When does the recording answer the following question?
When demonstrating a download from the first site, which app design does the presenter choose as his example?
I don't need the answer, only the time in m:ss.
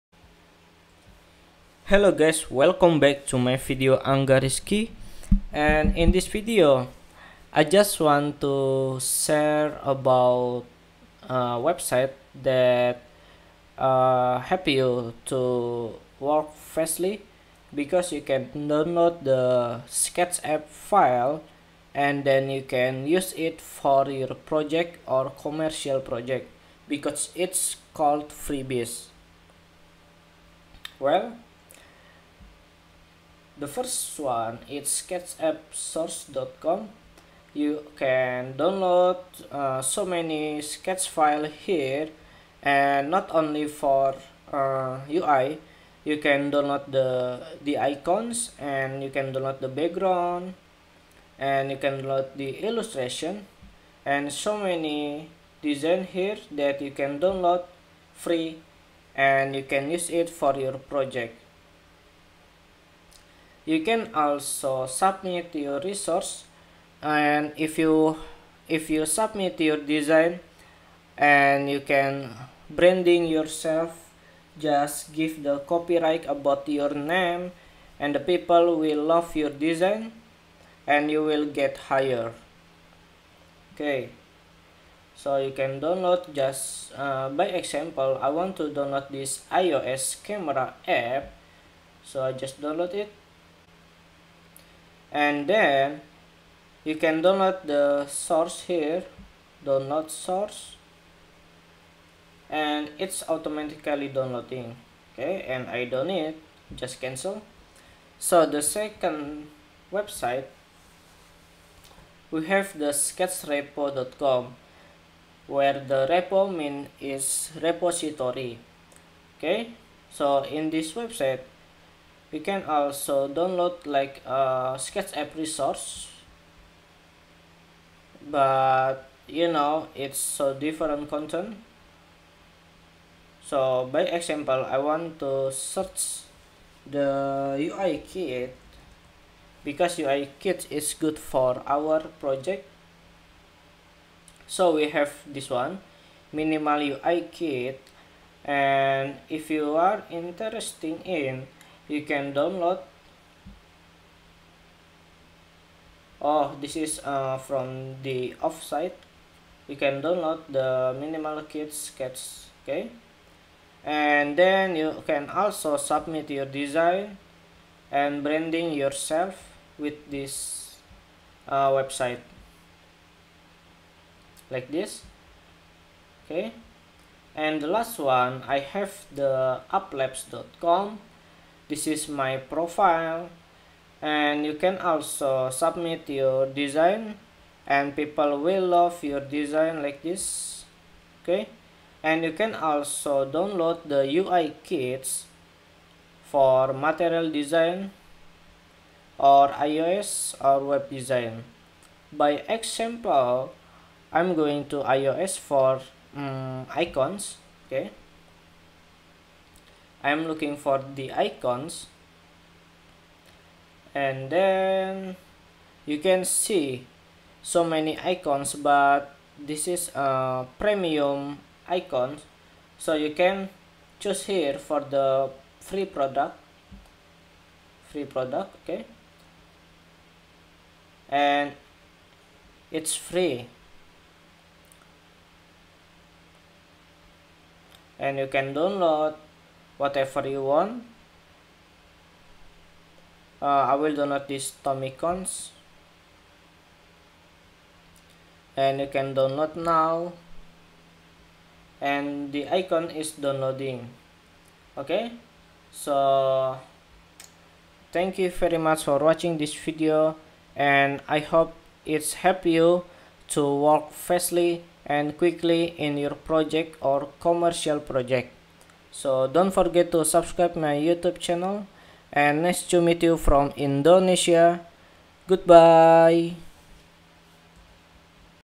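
1:29.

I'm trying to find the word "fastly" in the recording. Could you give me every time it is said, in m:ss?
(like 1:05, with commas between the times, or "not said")
0:16, 4:23.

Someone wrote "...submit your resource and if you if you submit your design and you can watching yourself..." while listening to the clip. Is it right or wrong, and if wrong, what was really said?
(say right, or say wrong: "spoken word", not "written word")
wrong: "branding", not "watching".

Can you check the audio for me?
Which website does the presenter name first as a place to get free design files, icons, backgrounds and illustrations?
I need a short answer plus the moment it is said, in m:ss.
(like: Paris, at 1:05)
sketchappsource.com, at 0:34.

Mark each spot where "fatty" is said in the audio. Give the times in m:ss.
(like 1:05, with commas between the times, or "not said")
not said.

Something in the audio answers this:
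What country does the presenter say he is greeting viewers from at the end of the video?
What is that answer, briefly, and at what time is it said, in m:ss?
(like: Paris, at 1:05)
Indonesia, at 4:33.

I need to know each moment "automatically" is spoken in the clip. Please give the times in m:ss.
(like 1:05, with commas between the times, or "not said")
1:43.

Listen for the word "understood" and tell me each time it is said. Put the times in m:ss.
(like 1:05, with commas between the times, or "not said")
not said.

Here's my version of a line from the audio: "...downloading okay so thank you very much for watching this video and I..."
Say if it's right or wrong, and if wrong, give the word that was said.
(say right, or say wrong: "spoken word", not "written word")
right.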